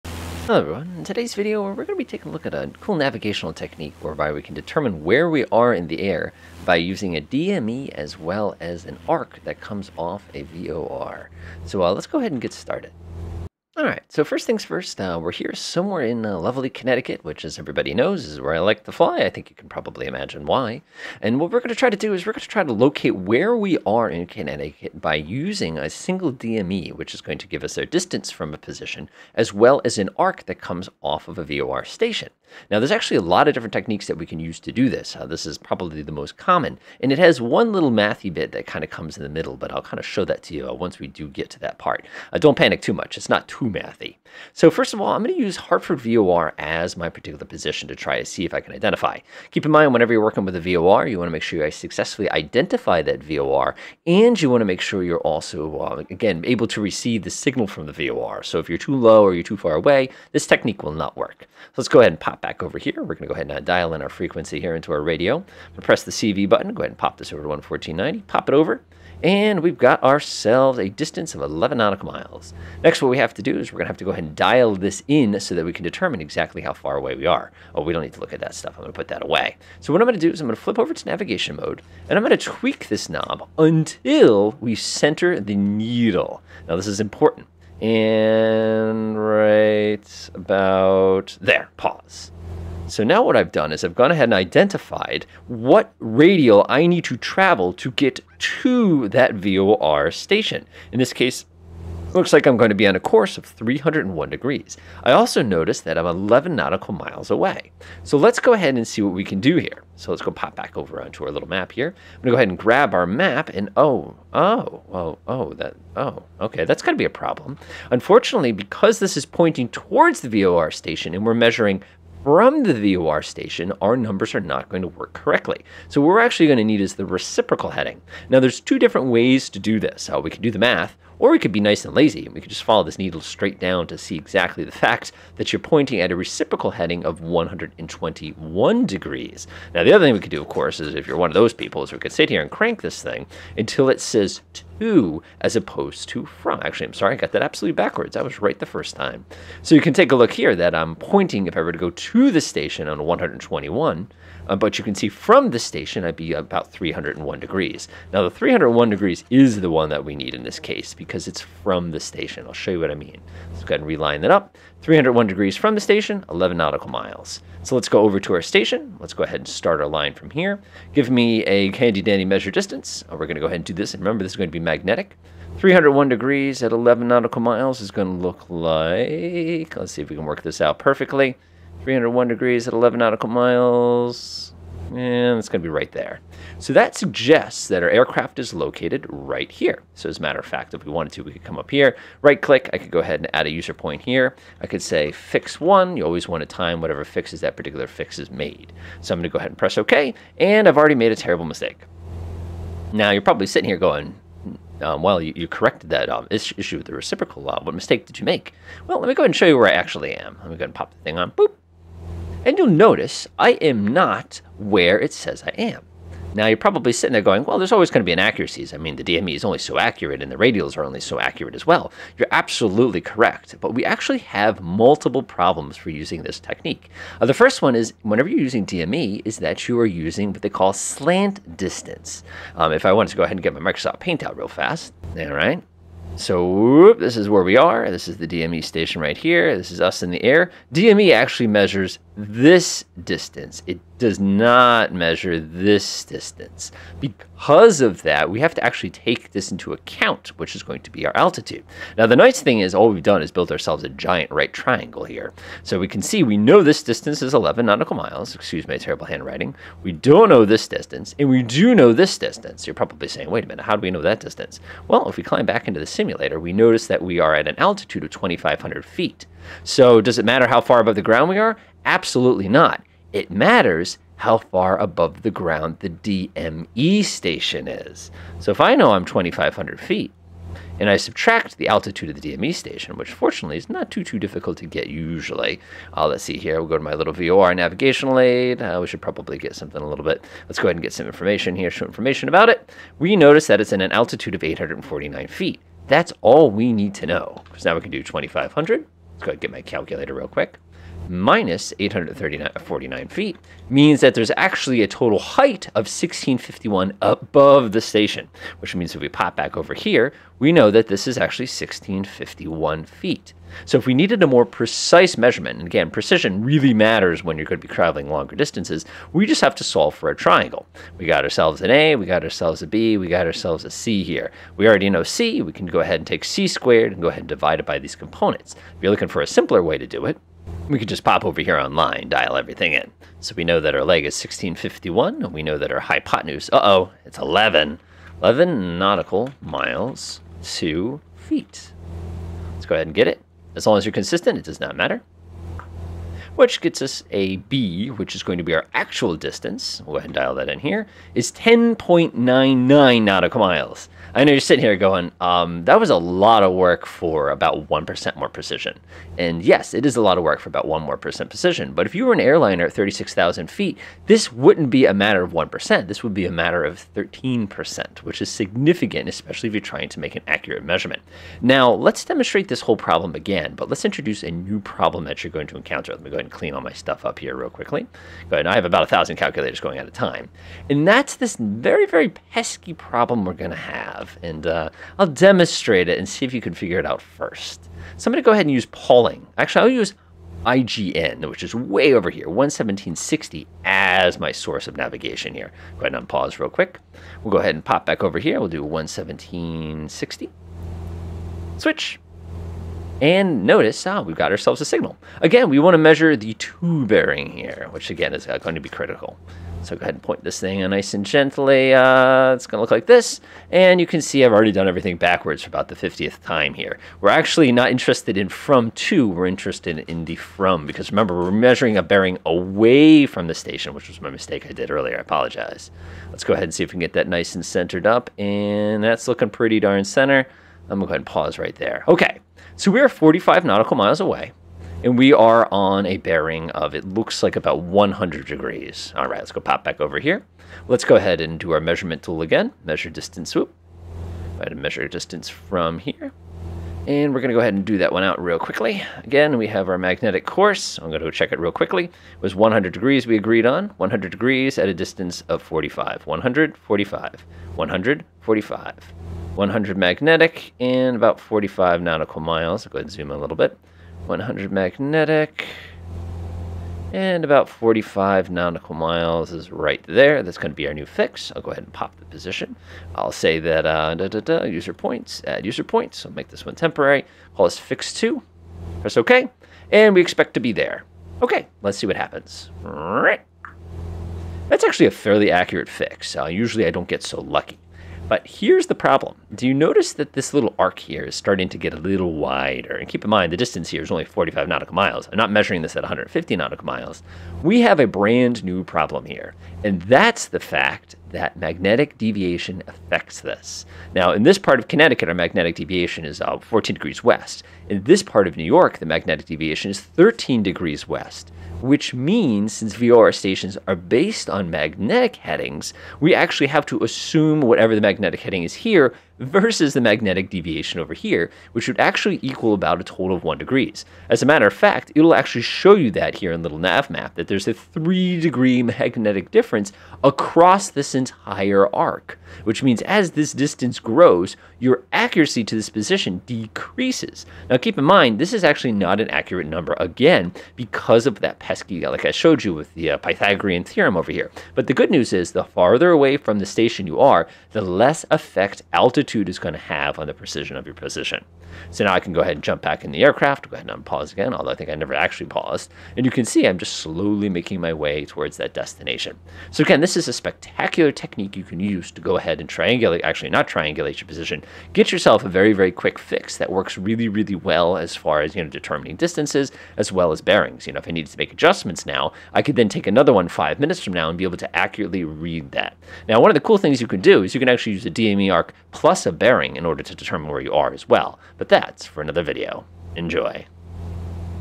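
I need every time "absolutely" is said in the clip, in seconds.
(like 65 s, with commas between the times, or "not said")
147 s, 222 s, 271 s.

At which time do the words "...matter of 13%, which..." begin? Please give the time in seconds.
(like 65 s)
366 s.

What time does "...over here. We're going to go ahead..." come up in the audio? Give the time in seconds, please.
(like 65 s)
62 s.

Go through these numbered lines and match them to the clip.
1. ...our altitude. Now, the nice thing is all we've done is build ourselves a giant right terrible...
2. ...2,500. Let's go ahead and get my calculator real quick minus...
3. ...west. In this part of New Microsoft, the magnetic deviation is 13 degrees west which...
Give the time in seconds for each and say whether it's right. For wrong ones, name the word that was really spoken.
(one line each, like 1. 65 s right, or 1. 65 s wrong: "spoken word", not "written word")
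1. 251 s wrong: "triangle", not "terrible"
2. 298 s right
3. 507 s wrong: "York", not "Microsoft".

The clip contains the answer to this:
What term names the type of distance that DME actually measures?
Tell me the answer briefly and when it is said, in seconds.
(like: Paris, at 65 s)
slant distance, at 230 s.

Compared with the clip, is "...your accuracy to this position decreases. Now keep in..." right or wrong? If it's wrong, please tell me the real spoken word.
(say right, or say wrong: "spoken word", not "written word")
right.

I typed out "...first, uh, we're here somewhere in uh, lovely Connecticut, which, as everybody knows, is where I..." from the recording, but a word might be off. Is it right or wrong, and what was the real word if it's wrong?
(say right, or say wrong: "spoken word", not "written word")
right.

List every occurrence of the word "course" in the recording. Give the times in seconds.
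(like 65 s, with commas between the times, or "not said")
102 s, 140 s, 450 s.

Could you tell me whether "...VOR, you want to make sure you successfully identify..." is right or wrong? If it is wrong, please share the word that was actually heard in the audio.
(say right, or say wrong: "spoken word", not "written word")
right.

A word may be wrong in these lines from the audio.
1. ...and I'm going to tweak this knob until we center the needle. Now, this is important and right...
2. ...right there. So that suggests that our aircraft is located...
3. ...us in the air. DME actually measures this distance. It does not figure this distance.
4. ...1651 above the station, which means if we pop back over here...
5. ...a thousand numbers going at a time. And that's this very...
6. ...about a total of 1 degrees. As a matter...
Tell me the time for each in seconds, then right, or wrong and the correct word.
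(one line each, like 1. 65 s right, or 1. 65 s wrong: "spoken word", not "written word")
1. 82 s right
2. 185 s right
3. 239 s wrong: "measure", not "figure"
4. 305 s right
5. 378 s wrong: "calculators", not "numbers"
6. 522 s right.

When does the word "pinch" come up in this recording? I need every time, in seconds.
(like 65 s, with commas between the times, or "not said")
not said.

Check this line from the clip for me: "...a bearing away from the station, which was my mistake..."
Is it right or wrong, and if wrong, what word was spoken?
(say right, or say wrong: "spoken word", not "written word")
right.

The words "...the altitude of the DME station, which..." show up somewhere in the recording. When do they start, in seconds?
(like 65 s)
281 s.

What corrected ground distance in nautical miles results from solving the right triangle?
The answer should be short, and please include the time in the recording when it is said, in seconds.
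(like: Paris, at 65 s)
10.99, at 351 s.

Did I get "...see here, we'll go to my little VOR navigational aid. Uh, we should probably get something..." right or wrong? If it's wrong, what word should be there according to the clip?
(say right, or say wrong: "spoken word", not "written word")
right.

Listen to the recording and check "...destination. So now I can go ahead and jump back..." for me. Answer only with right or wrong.
wrong.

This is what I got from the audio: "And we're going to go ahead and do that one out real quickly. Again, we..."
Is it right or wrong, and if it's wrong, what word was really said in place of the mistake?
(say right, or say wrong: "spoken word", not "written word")
right.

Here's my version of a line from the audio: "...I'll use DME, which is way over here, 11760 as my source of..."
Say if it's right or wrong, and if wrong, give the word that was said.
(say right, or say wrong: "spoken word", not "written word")
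wrong: "IGN", not "DME".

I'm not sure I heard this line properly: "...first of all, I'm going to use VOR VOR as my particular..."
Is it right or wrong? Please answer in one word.
wrong.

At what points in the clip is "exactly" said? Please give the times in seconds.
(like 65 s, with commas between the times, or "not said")
76 s, 134 s.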